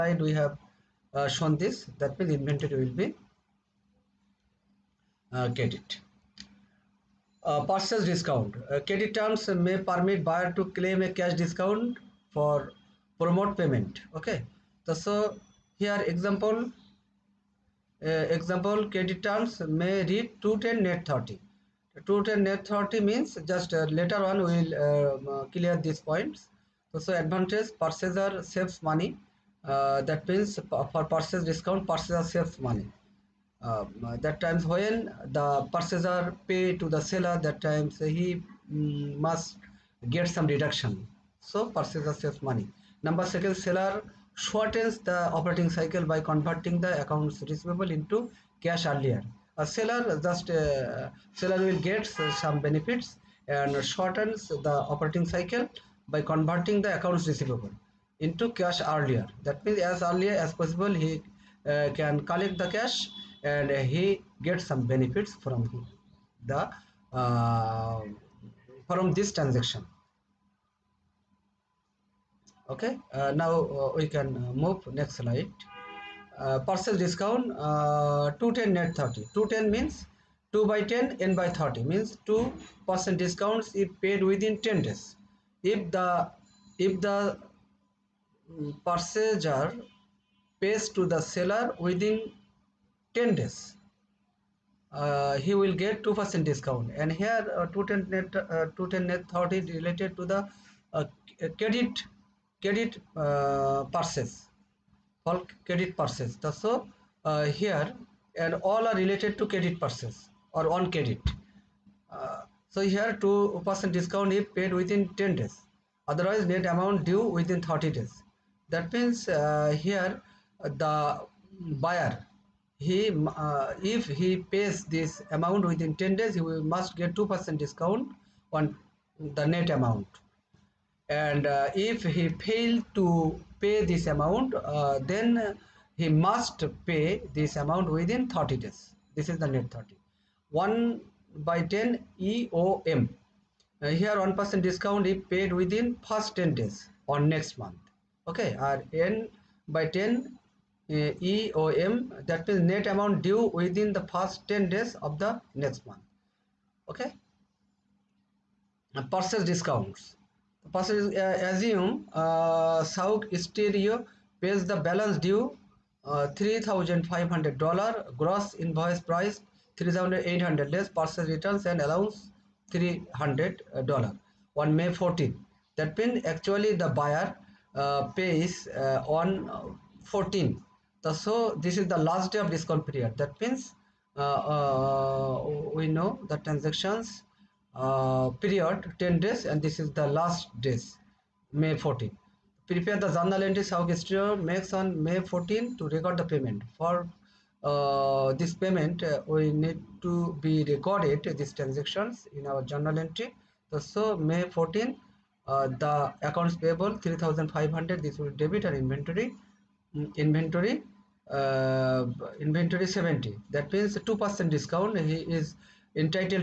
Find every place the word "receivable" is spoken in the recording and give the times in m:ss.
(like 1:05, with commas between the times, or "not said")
0:47, 0:57.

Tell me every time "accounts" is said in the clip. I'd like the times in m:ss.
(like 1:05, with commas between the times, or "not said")
0:46, 0:56, 3:26.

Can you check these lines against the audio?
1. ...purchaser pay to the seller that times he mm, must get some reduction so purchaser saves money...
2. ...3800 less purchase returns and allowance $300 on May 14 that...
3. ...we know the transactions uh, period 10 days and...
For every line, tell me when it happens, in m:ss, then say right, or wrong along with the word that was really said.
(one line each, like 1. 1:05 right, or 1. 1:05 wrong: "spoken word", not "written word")
1. 0:35 right
2. 2:49 right
3. 3:05 right.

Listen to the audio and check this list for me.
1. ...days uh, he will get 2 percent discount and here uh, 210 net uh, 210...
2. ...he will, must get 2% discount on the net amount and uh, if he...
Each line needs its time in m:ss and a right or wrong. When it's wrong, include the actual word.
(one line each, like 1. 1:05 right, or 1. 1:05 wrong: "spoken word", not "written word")
1. 1:33 right
2. 2:06 right.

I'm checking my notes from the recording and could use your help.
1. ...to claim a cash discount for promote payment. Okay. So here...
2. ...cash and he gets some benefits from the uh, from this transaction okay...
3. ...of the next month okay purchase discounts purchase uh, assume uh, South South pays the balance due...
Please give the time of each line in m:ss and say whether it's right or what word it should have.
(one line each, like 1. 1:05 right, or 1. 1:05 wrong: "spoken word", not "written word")
1. 0:10 right
2. 1:02 right
3. 2:34 wrong: "Stereo", not "South".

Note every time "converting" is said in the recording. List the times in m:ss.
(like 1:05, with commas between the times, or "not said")
0:46, 0:56.